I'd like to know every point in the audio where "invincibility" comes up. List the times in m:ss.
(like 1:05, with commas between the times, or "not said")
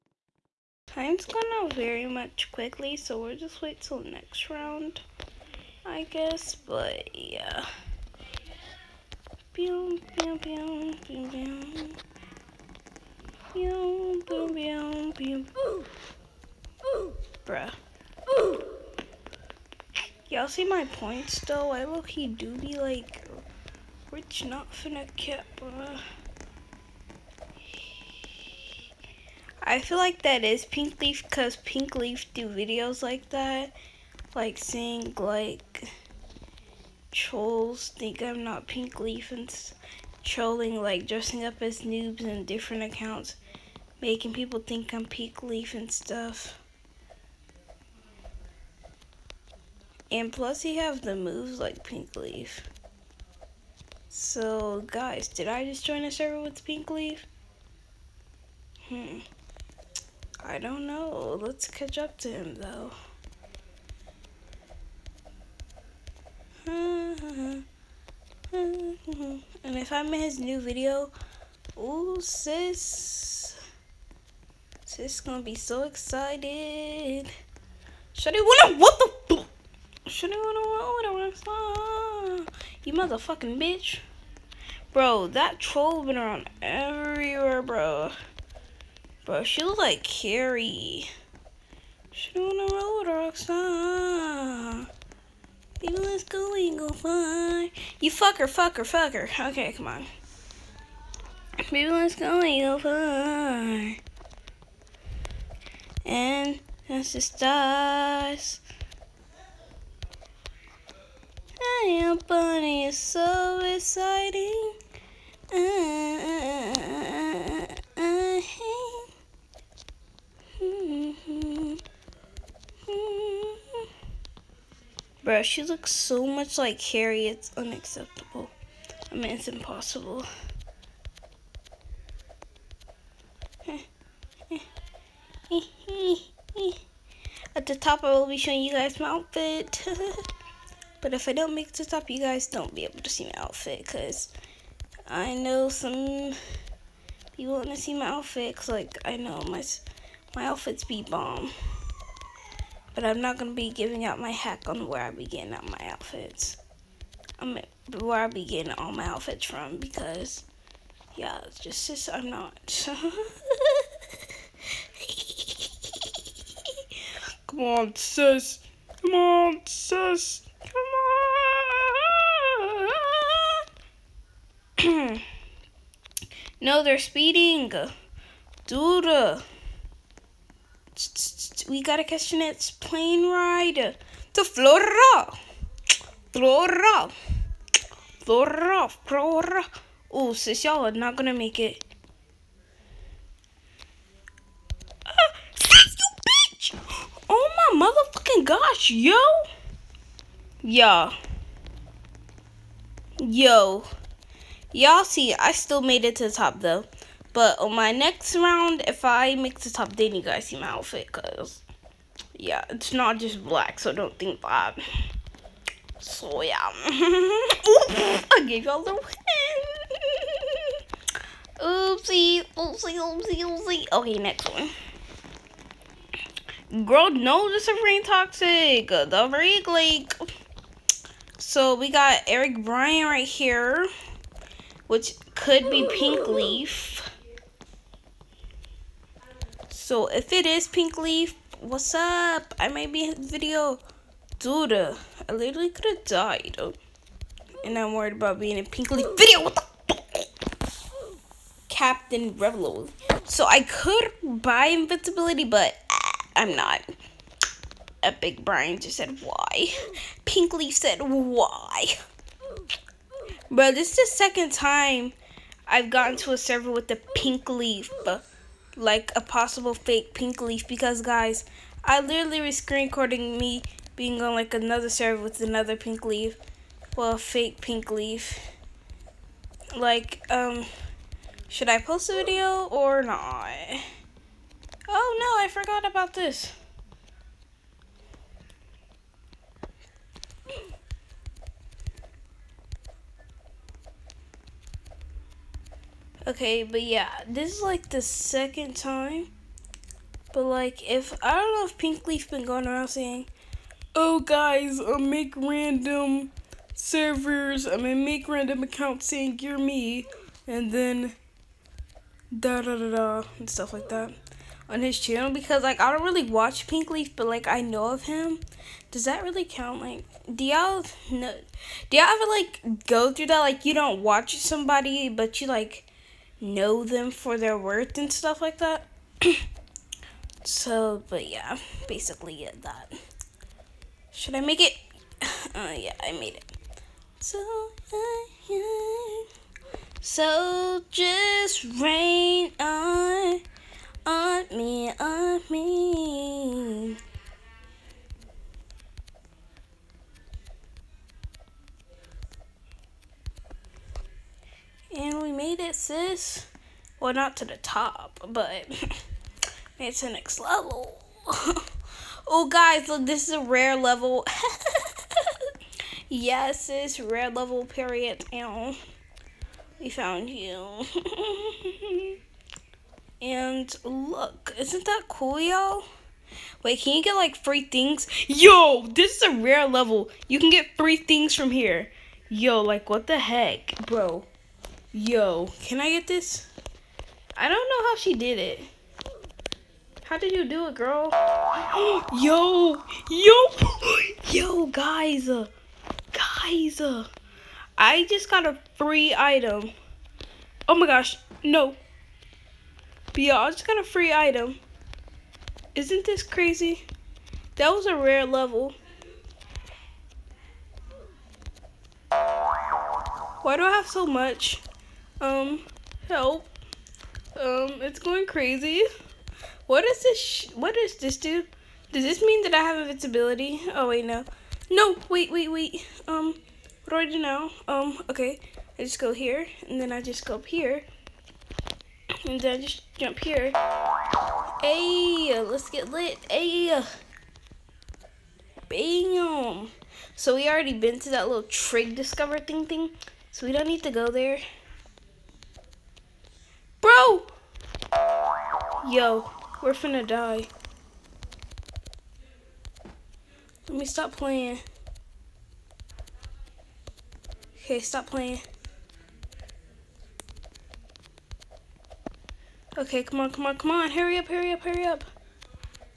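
4:14, 7:02.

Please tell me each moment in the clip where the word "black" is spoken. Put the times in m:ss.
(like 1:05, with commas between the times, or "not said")
3:33.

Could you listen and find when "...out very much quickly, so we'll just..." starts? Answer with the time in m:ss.
0:01.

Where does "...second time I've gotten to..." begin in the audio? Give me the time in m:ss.
4:24.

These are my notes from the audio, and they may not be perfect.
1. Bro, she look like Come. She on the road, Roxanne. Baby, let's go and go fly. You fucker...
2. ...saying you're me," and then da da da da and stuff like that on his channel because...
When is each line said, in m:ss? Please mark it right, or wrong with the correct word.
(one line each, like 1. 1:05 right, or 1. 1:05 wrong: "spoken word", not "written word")
1. 1:29 wrong: "Carrie", not "Come"
2. 5:09 right.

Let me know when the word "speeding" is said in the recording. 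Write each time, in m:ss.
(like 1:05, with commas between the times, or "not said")
2:56.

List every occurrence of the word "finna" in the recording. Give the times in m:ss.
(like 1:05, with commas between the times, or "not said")
0:24, 7:29.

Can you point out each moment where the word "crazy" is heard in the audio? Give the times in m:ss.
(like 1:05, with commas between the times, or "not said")
6:46, 6:58.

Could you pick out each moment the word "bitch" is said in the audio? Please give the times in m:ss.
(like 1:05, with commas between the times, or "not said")
1:23, 3:15.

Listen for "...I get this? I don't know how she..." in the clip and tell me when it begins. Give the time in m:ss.
6:25.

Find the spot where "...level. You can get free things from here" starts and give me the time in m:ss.
6:19.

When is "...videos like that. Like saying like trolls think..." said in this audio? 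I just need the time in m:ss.
0:32.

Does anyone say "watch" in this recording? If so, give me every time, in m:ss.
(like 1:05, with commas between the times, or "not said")
5:16, 5:24.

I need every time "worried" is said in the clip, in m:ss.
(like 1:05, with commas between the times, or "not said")
4:07.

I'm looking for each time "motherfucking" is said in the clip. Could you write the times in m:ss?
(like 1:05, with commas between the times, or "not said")
1:22, 3:17.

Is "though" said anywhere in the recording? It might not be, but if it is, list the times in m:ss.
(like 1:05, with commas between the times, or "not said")
0:21, 1:02, 3:26.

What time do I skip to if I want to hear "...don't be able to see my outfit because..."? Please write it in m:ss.
2:22.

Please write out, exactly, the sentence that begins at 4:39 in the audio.
Like, um, should I post the video or not?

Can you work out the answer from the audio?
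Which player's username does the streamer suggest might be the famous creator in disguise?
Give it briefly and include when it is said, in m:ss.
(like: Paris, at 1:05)
Eric Bryan, at 3:52.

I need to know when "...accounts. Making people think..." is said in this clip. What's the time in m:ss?
0:42.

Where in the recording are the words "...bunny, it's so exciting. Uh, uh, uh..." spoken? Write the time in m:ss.
1:52.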